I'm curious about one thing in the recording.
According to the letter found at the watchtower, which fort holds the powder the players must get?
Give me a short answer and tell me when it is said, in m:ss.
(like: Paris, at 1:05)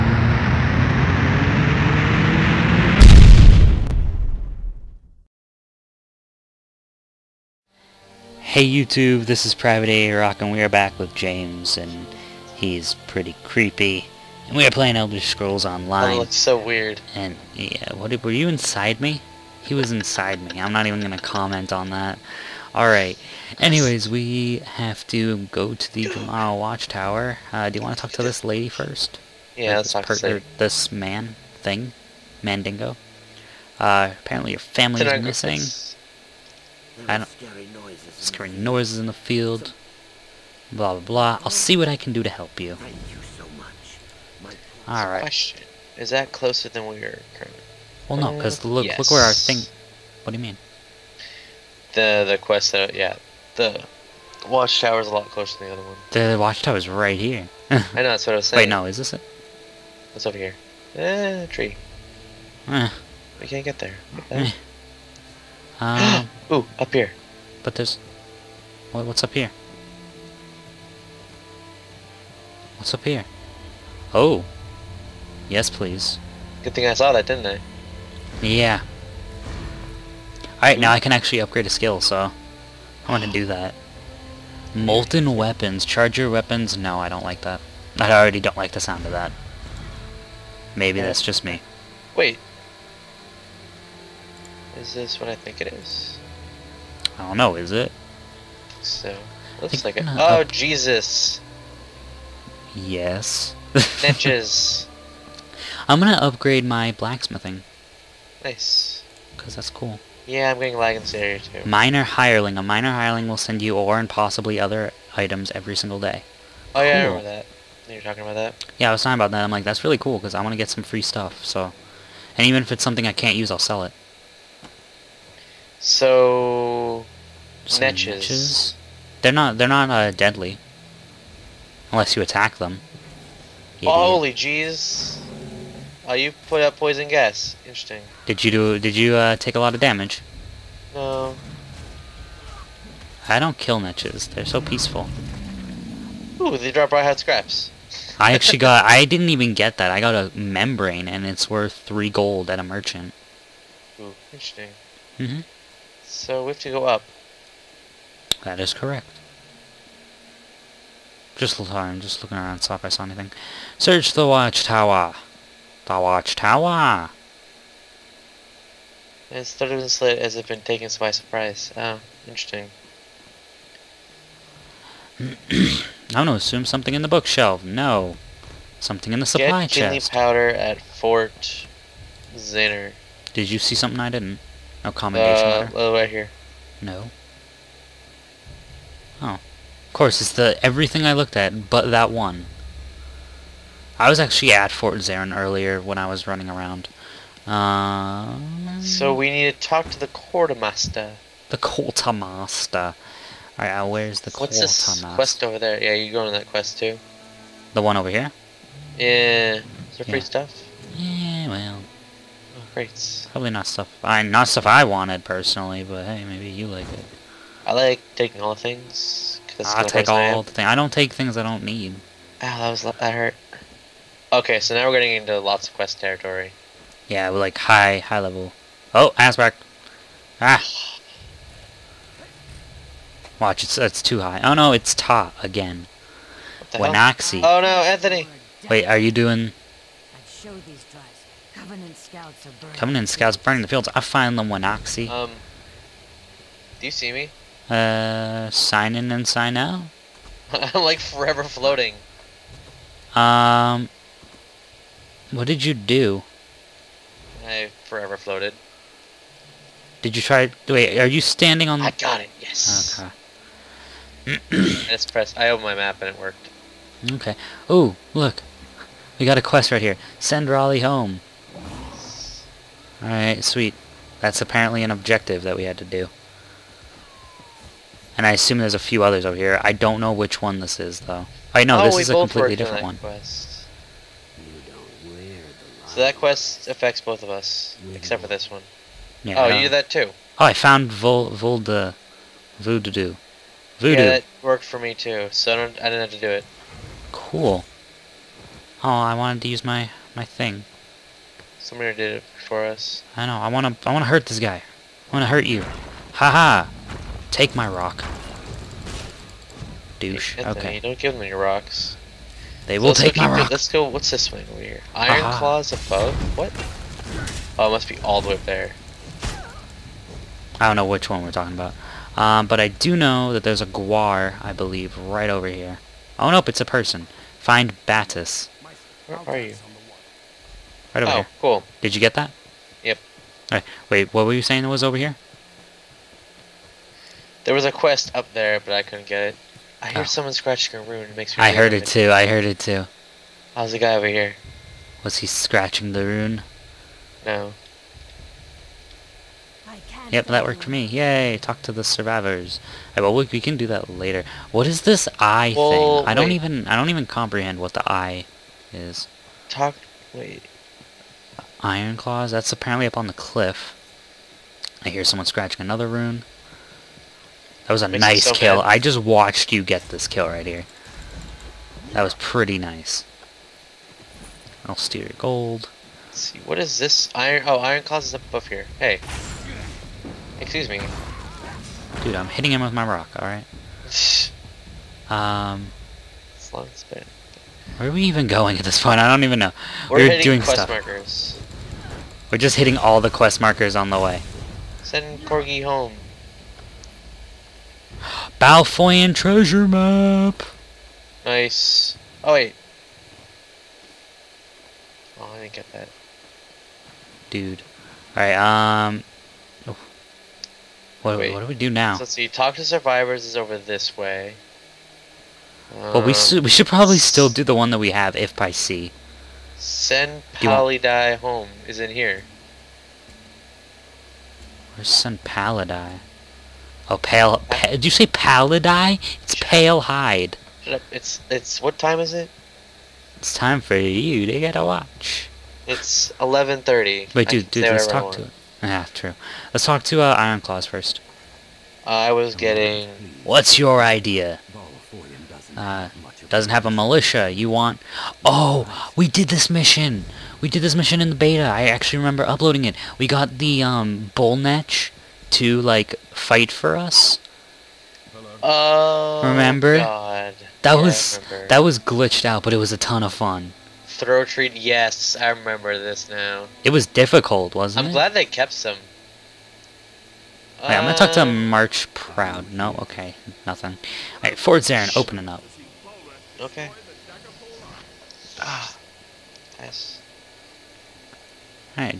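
Fort Zinner, at 3:00.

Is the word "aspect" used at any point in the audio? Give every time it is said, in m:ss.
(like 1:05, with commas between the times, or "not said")
3:49.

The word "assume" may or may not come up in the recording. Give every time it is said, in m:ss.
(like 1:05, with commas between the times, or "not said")
2:56, 4:38.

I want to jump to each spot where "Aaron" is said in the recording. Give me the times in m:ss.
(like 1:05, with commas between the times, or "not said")
not said.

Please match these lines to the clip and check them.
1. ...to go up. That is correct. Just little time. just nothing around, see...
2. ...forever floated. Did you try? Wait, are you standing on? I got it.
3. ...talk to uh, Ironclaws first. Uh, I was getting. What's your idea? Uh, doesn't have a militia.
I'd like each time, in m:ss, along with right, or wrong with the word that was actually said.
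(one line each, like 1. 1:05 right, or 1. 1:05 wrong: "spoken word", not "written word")
1. 2:36 wrong: "looking", not "nothing"
2. 4:17 right
3. 7:19 right.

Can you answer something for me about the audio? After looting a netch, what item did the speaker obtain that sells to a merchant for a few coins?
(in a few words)
A membrane.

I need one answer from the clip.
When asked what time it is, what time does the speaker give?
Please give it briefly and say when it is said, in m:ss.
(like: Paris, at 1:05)
11:30, at 7:16.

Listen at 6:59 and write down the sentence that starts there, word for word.
Send Palidai home is in here.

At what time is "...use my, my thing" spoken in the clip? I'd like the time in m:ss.
4:59.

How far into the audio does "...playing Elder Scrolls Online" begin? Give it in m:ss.
0:14.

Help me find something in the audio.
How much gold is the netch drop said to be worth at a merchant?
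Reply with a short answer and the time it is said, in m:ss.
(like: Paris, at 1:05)
3 gold, at 2:31.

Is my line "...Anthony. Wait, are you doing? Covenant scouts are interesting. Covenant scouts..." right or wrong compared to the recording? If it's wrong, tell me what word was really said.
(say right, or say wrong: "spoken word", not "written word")
wrong: "burning", not "interesting".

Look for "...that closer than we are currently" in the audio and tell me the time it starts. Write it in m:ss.
0:46.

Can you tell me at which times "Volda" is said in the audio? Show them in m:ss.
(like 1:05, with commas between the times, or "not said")
4:51.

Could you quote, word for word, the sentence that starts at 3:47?
Yeah, we're like high, high level.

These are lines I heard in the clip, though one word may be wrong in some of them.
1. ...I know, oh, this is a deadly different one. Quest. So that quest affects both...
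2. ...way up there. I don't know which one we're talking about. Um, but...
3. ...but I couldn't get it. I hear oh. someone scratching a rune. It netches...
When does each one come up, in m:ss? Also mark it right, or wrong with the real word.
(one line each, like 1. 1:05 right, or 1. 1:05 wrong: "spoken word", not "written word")
1. 4:41 wrong: "completely", not "deadly"
2. 5:18 right
3. 5:38 wrong: "makes", not "netches".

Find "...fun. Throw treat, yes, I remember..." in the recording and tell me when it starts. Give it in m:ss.
7:43.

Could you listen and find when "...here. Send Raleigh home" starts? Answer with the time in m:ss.
4:29.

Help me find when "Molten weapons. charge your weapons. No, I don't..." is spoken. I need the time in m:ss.
1:24.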